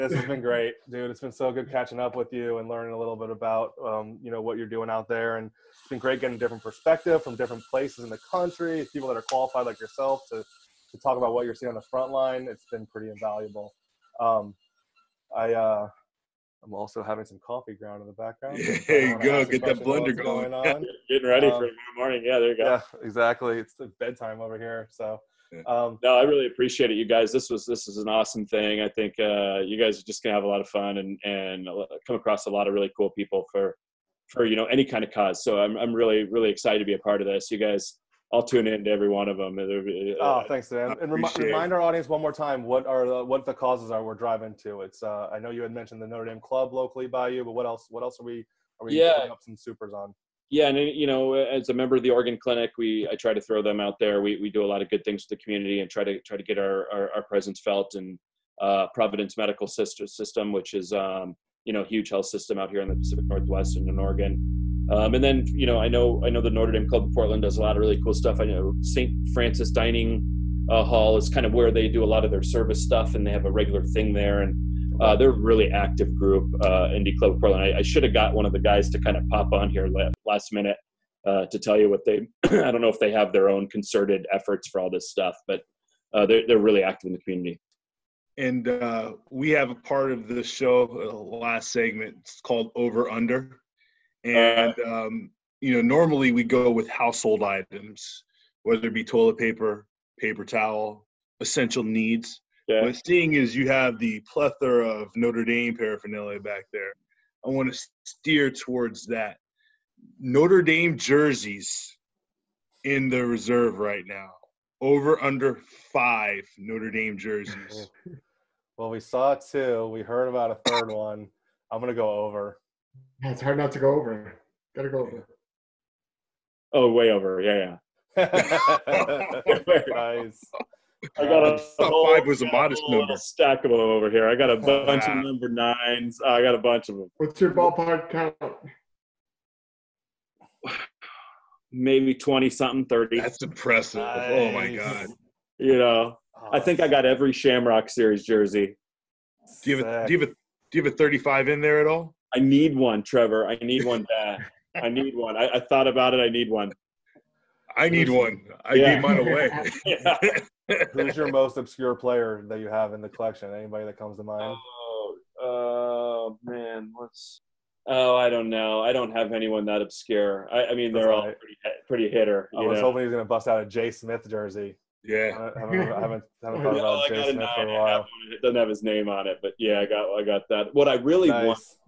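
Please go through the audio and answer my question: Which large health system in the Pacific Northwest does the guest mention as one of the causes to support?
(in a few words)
Providence Medical System.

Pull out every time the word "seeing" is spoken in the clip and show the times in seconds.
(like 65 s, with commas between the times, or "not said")
11 s, 103 s.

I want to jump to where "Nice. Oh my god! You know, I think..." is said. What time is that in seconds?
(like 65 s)
144 s.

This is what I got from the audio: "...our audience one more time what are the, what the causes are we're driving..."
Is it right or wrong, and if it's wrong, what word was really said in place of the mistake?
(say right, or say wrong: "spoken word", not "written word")
right.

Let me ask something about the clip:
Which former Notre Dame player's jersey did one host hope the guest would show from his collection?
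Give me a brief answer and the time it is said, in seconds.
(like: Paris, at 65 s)
Jaylon Smith, at 173 s.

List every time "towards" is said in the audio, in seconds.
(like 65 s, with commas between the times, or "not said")
108 s.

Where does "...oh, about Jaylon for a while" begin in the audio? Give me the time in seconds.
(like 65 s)
176 s.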